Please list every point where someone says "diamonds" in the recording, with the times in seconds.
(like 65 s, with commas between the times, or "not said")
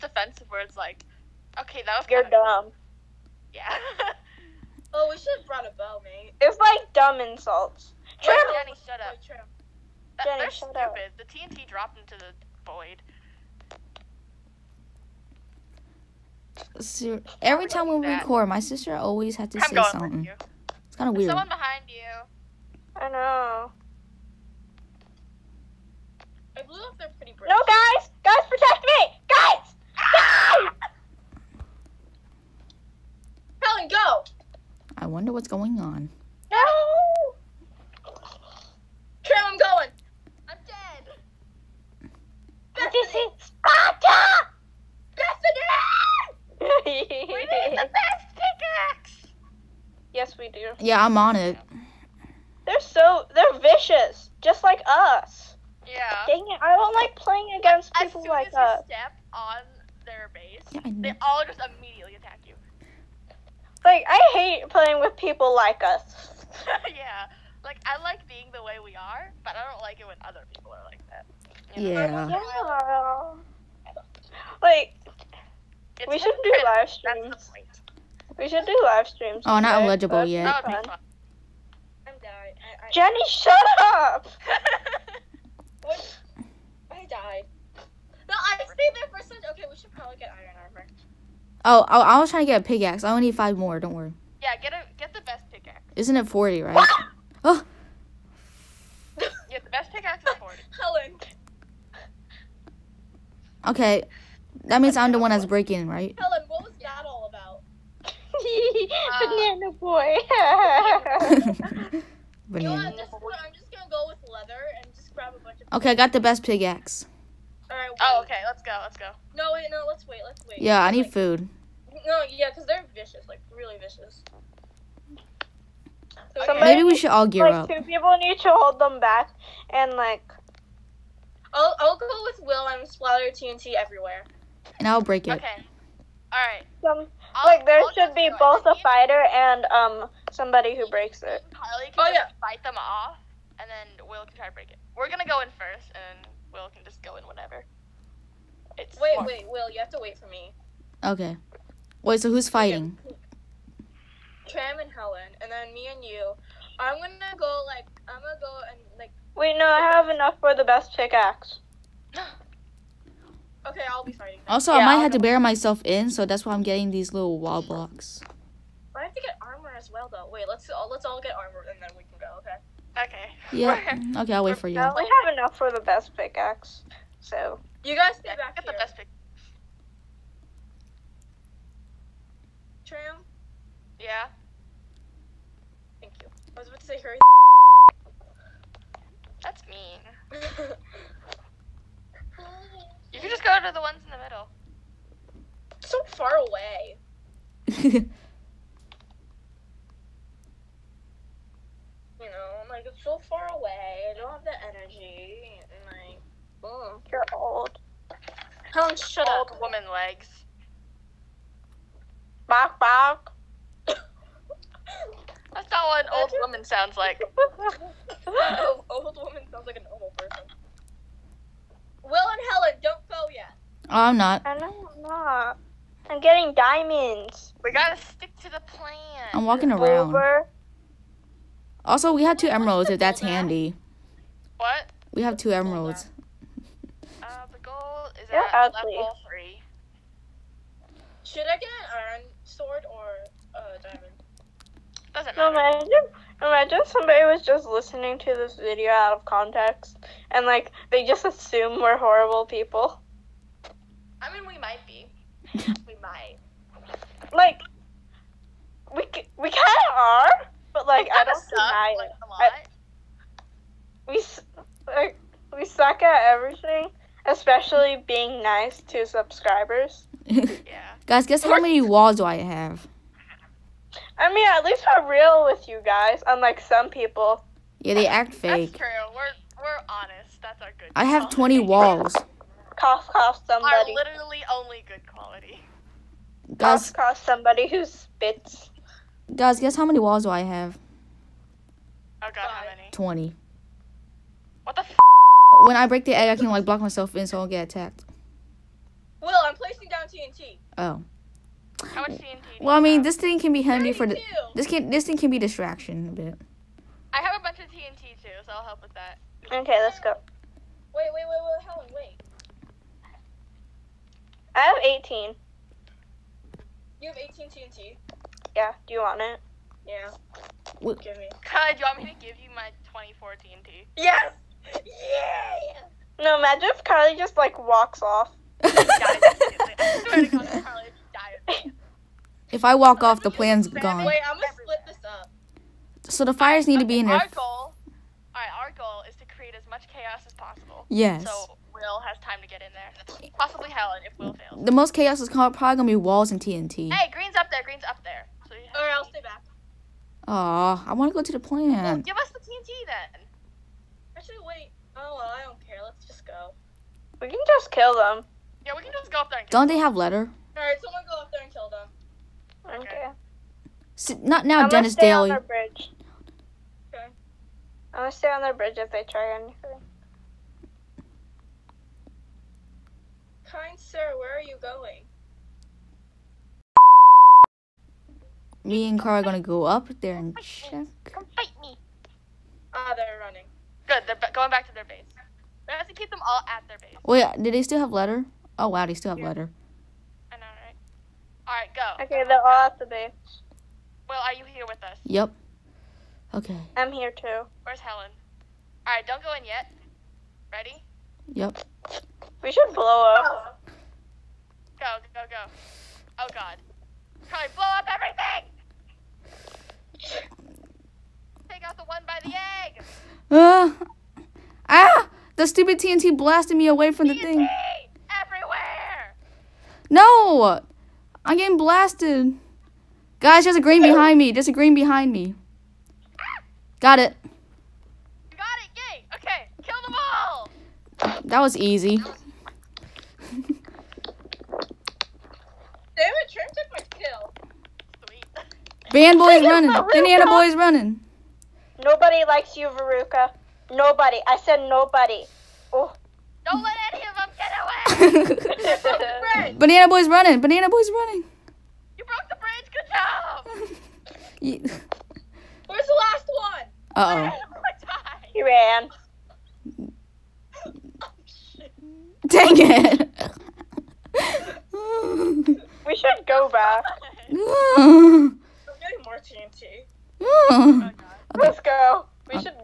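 226 s, 243 s.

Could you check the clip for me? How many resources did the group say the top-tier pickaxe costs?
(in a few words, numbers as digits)
40.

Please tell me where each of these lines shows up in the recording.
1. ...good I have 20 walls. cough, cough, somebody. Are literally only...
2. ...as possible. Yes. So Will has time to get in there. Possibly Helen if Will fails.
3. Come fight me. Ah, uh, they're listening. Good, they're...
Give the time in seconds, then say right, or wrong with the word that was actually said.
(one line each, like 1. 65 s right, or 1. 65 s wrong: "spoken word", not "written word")
1. 280 s right
2. 340 s right
3. 381 s wrong: "running", not "listening".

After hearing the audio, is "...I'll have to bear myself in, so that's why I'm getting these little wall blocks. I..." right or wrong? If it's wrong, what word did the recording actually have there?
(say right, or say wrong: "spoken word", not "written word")
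right.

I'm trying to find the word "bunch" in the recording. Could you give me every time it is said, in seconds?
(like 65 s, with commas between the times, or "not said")
115 s, 307 s.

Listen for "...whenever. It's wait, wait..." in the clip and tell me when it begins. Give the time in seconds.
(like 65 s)
147 s.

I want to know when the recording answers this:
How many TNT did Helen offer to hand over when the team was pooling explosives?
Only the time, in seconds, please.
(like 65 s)
322 s.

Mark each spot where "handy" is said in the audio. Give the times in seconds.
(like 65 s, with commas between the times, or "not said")
233 s, 303 s.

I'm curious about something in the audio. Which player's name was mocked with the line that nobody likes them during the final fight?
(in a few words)
Veruca.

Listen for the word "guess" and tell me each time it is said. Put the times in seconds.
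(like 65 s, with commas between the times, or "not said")
271 s, 289 s.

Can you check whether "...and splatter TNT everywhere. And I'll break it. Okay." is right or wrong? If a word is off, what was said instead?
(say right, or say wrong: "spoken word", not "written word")
right.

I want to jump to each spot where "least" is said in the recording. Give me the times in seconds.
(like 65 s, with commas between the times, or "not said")
274 s.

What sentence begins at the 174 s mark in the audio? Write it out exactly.
We have enough for the best pickaxe, so you guys stay back.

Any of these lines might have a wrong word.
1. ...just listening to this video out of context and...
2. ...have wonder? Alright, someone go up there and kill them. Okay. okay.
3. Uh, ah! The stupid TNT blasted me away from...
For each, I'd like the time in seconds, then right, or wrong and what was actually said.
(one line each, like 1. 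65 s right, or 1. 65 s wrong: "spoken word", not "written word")
1. 247 s right
2. 359 s wrong: "letter", not "wonder"
3. 413 s right.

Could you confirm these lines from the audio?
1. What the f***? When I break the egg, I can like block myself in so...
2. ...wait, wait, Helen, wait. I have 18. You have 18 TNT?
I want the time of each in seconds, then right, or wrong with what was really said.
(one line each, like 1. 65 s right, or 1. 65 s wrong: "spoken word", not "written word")
1. 294 s right
2. 311 s right.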